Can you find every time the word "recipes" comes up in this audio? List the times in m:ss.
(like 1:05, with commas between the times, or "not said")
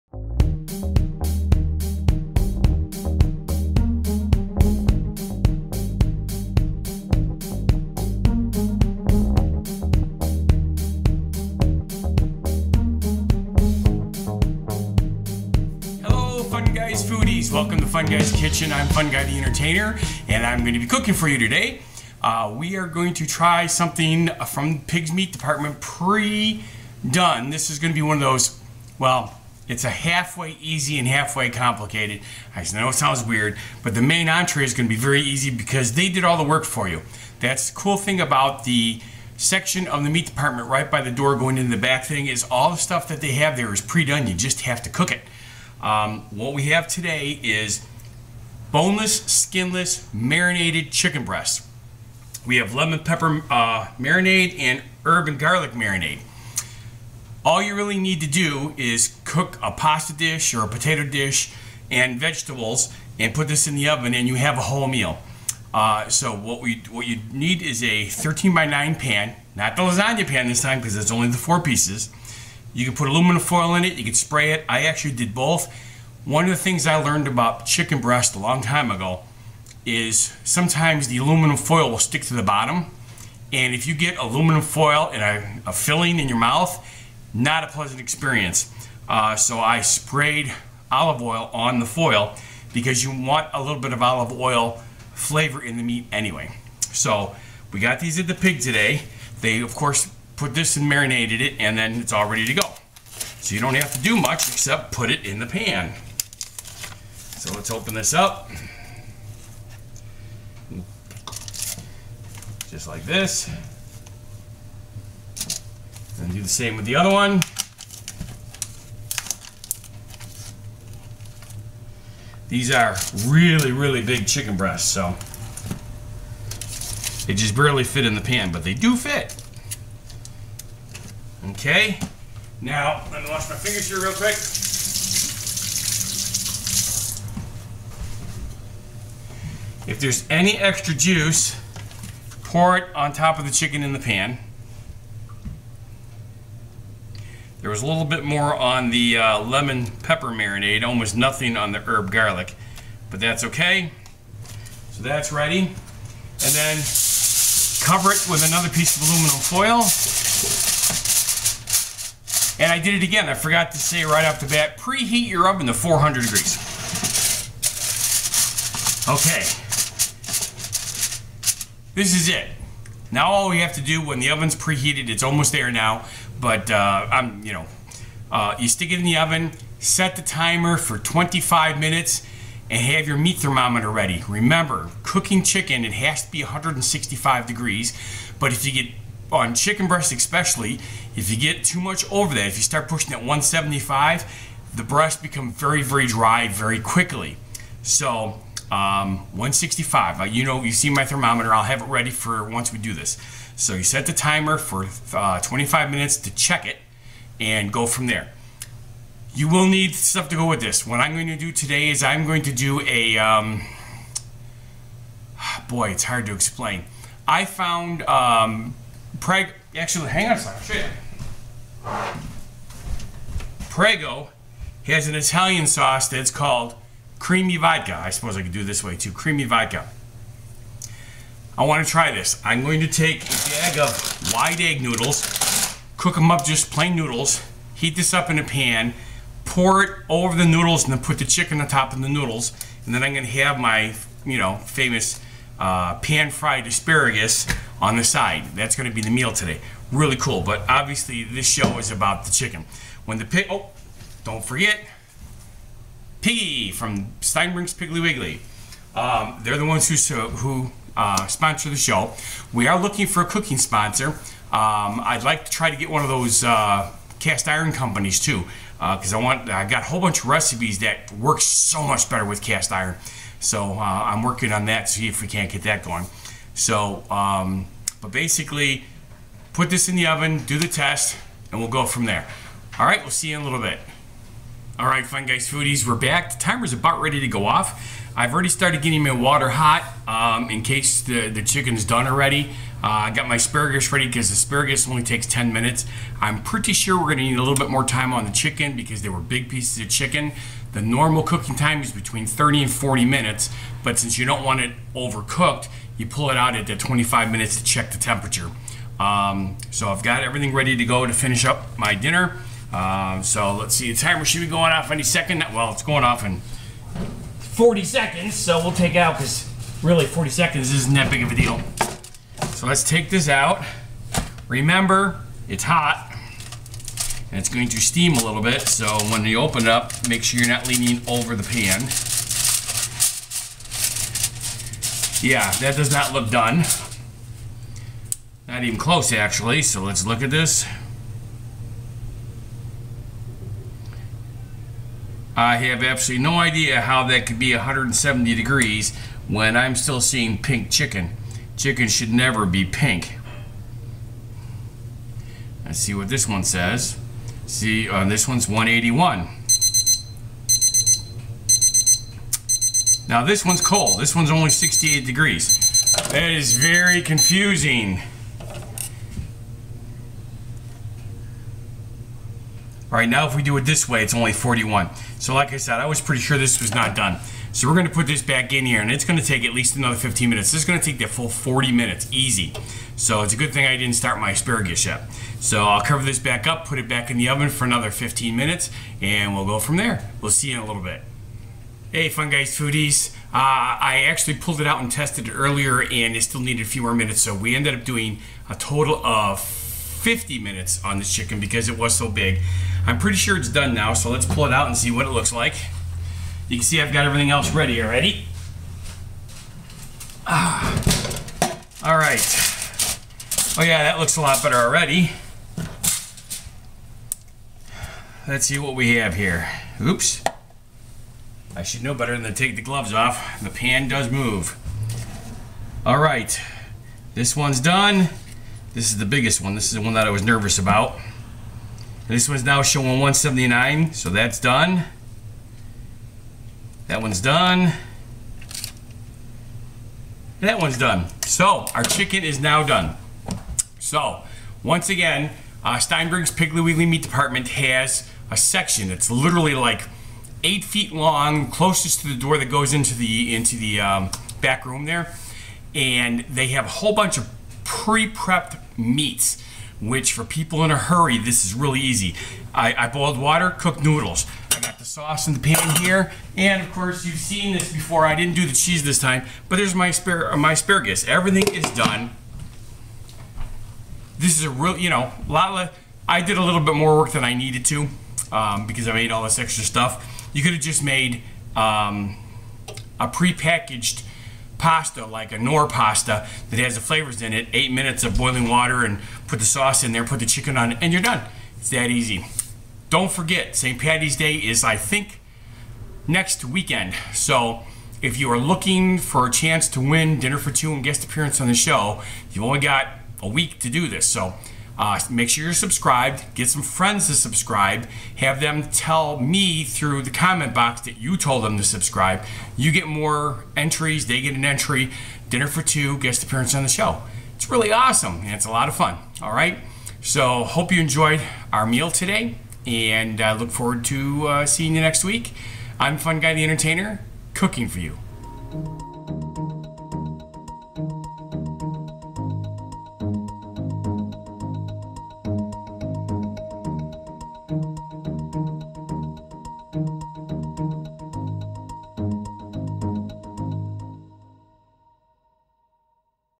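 4:30.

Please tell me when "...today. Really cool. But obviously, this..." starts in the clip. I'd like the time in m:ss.
4:09.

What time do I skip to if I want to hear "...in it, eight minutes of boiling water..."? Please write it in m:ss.
8:07.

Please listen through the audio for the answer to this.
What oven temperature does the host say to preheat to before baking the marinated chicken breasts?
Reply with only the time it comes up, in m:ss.
2:45.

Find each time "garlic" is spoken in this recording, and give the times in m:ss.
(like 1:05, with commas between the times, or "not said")
0:55, 2:32.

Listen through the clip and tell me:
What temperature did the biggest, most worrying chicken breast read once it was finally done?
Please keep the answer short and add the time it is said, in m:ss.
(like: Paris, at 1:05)
179, at 7:12.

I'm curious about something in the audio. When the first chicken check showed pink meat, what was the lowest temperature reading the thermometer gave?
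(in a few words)
41.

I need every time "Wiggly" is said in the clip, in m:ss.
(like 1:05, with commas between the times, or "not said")
4:18, 7:26.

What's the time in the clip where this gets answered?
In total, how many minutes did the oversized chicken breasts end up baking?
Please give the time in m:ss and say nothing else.
6:39.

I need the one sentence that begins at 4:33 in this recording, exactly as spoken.
So uh, I'm working on that.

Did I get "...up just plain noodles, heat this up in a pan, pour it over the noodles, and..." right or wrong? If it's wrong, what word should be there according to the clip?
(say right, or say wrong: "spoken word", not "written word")
right.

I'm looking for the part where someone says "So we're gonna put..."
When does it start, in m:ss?
6:17.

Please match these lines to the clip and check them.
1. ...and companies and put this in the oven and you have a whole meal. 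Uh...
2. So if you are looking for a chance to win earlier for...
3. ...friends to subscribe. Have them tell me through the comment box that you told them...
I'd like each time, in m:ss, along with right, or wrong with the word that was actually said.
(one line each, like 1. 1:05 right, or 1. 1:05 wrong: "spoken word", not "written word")
1. 1:01 wrong: "vegetables", not "companies"
2. 8:17 wrong: "dinner", not "earlier"
3. 8:26 right.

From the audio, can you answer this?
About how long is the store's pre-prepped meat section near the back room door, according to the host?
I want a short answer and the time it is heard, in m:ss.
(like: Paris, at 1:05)
8 feet, at 7:30.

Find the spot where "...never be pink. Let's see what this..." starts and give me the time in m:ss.
5:52.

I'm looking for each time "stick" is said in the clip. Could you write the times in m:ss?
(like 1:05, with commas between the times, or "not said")
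1:21, 2:58.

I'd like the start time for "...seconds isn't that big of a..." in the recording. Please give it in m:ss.
5:20.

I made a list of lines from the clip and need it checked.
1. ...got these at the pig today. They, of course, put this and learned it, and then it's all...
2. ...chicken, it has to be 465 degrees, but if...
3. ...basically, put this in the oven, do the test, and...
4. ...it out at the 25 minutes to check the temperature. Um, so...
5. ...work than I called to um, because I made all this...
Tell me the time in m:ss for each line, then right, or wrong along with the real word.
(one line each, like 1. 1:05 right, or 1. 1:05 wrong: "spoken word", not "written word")
1. 1:37 wrong: "marinated", not "learned"
2. 3:05 wrong: "165", not "465"
3. 4:38 right
4. 5:06 right
5. 7:56 wrong: "needed", not "called".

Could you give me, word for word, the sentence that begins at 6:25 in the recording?
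So I'll cover this back up, put it back in the oven for another 15 minutes, and we'll go from there.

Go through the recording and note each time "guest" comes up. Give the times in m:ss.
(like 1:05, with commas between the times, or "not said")
8:20, 8:35.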